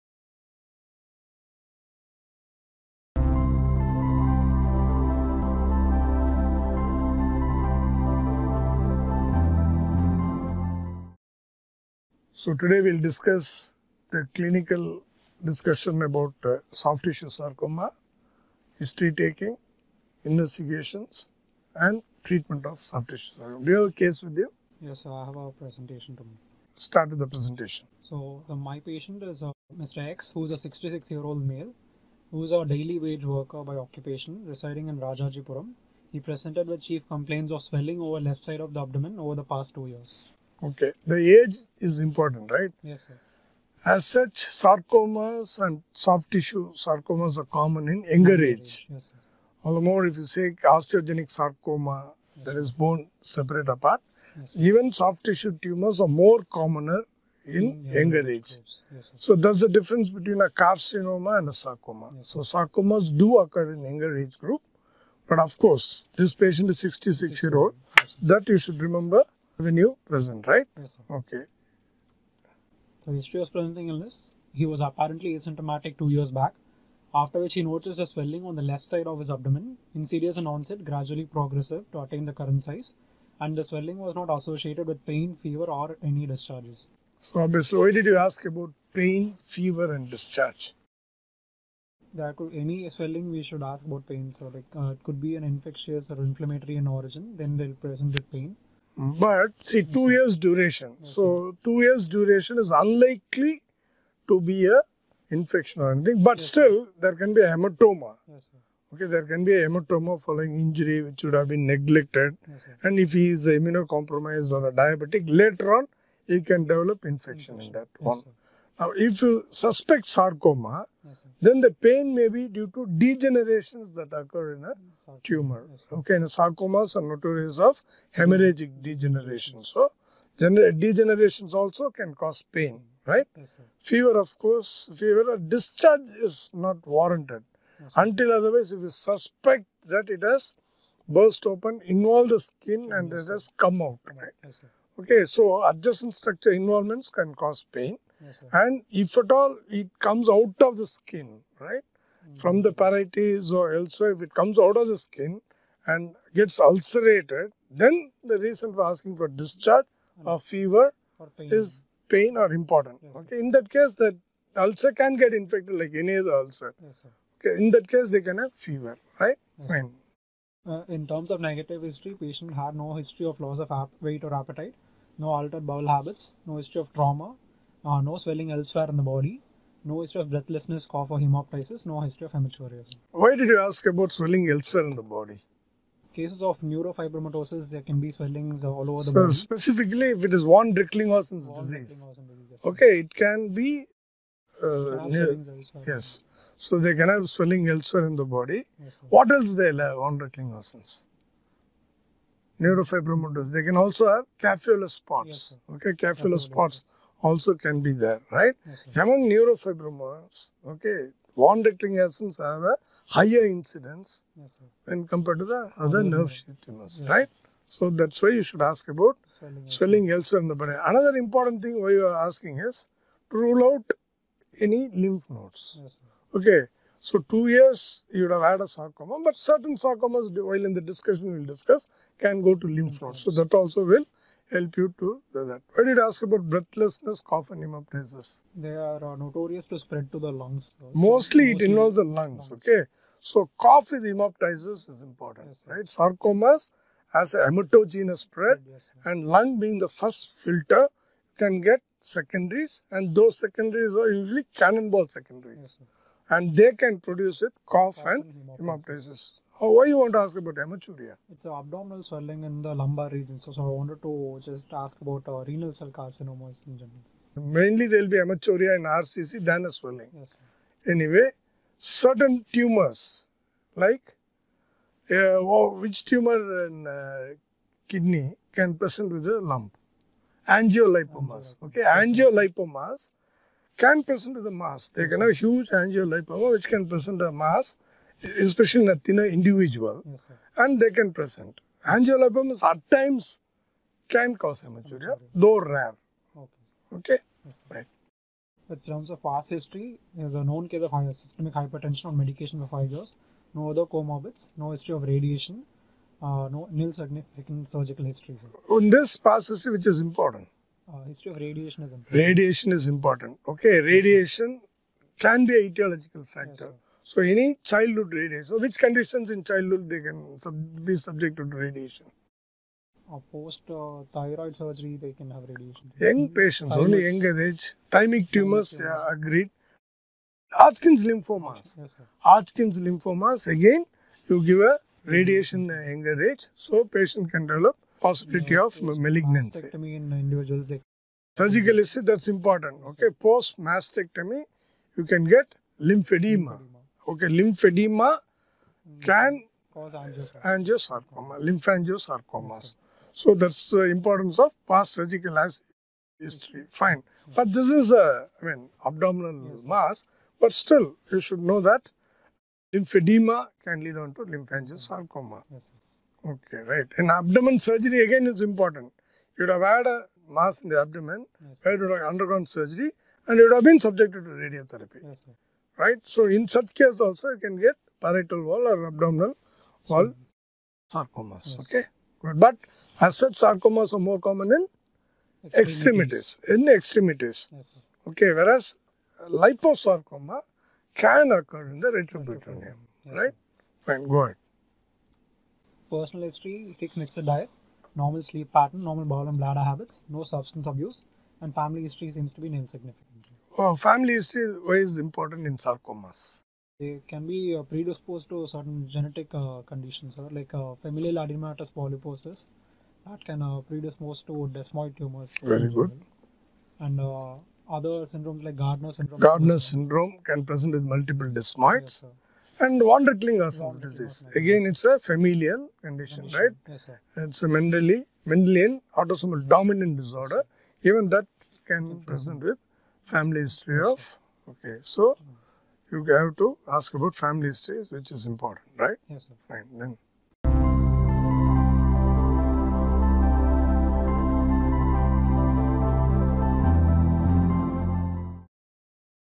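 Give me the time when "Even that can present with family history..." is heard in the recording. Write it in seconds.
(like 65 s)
430 s.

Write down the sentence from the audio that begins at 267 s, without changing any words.
Mainly there will be hematuria in RCC than a swelling.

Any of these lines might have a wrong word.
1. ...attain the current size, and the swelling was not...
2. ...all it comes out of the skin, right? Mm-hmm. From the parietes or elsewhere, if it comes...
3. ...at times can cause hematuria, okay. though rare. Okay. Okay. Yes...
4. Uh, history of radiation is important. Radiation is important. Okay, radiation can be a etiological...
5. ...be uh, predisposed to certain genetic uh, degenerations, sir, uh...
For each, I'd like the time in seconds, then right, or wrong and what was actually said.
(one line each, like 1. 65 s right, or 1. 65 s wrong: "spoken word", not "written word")
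1. 82 s right
2. 149 s right
3. 292 s right
4. 310 s right
5. 407 s wrong: "conditions", not "degenerations".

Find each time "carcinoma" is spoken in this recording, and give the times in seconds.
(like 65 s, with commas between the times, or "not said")
60 s, 265 s.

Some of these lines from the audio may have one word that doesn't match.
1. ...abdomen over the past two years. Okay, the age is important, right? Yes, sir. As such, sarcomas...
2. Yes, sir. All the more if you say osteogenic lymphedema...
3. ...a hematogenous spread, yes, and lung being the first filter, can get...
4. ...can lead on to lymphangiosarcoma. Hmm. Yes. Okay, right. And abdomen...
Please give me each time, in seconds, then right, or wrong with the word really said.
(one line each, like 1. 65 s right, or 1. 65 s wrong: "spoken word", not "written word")
1. 38 s right
2. 48 s wrong: "sarcoma", not "lymphedema"
3. 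247 s right
4. 363 s right.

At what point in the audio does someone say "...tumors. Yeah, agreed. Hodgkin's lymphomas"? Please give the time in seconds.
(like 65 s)
328 s.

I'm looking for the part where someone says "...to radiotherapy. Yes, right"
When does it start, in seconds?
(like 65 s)
374 s.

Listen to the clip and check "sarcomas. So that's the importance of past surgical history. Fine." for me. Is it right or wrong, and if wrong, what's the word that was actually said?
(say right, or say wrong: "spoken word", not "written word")
wrong: "lymphangiosarcomas", not "sarcomas".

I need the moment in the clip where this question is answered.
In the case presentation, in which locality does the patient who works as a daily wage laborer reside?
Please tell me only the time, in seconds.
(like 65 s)
34 s.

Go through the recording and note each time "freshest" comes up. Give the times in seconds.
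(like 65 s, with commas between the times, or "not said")
not said.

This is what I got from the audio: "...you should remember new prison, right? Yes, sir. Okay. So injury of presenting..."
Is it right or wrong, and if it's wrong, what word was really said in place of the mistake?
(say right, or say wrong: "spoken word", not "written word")
wrong: "history", not "injury".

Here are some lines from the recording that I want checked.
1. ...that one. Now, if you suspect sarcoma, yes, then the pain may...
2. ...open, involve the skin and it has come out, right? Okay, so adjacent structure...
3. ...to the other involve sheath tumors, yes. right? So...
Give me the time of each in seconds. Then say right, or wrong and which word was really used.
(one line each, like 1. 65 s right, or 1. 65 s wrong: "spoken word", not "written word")
1. 117 s right
2. 141 s right
3. 215 s wrong: "nerve", not "involve".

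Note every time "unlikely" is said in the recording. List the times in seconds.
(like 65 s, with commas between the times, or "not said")
102 s.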